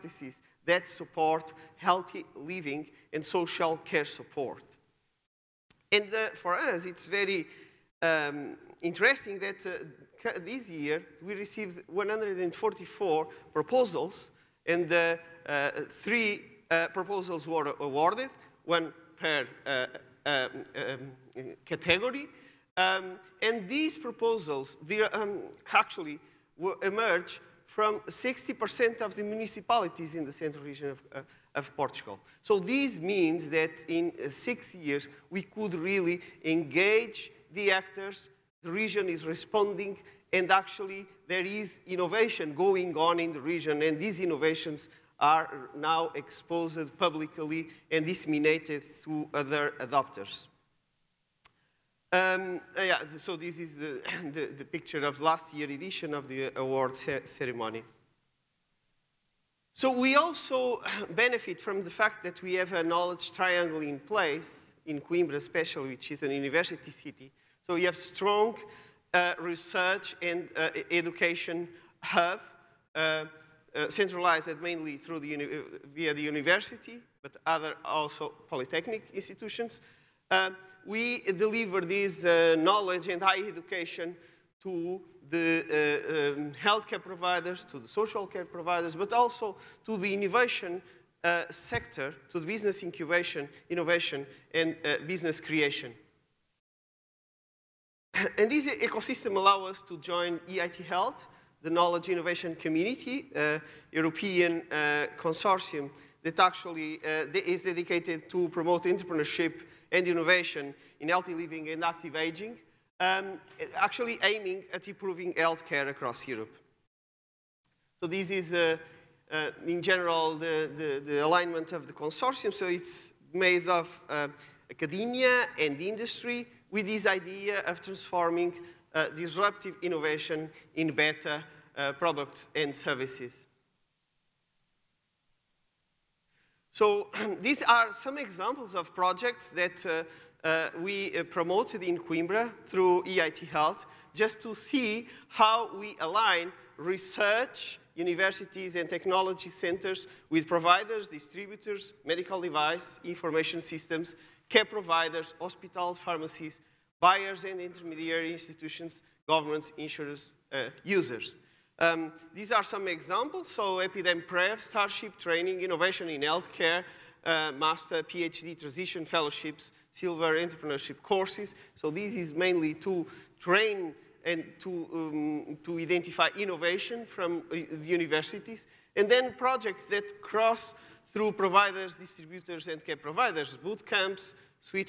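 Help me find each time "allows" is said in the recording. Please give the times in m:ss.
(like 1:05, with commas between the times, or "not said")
1:39.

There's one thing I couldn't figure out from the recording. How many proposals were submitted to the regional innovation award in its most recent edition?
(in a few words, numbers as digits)
144.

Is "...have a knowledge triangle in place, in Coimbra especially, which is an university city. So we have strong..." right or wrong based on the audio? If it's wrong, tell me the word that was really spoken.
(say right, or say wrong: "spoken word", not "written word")
right.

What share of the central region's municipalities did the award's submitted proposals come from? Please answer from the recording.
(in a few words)
60%.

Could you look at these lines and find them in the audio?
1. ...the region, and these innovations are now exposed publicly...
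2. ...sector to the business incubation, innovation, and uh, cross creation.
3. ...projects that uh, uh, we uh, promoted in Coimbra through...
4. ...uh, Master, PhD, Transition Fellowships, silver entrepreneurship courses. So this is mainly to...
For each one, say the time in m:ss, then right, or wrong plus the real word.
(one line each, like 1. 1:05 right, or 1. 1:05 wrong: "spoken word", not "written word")
1. 0:43 right
2. 1:31 wrong: "business", not "cross"
3. 2:18 right
4. 2:47 right.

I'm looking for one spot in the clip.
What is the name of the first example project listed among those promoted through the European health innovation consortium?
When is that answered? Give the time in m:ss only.
2:43.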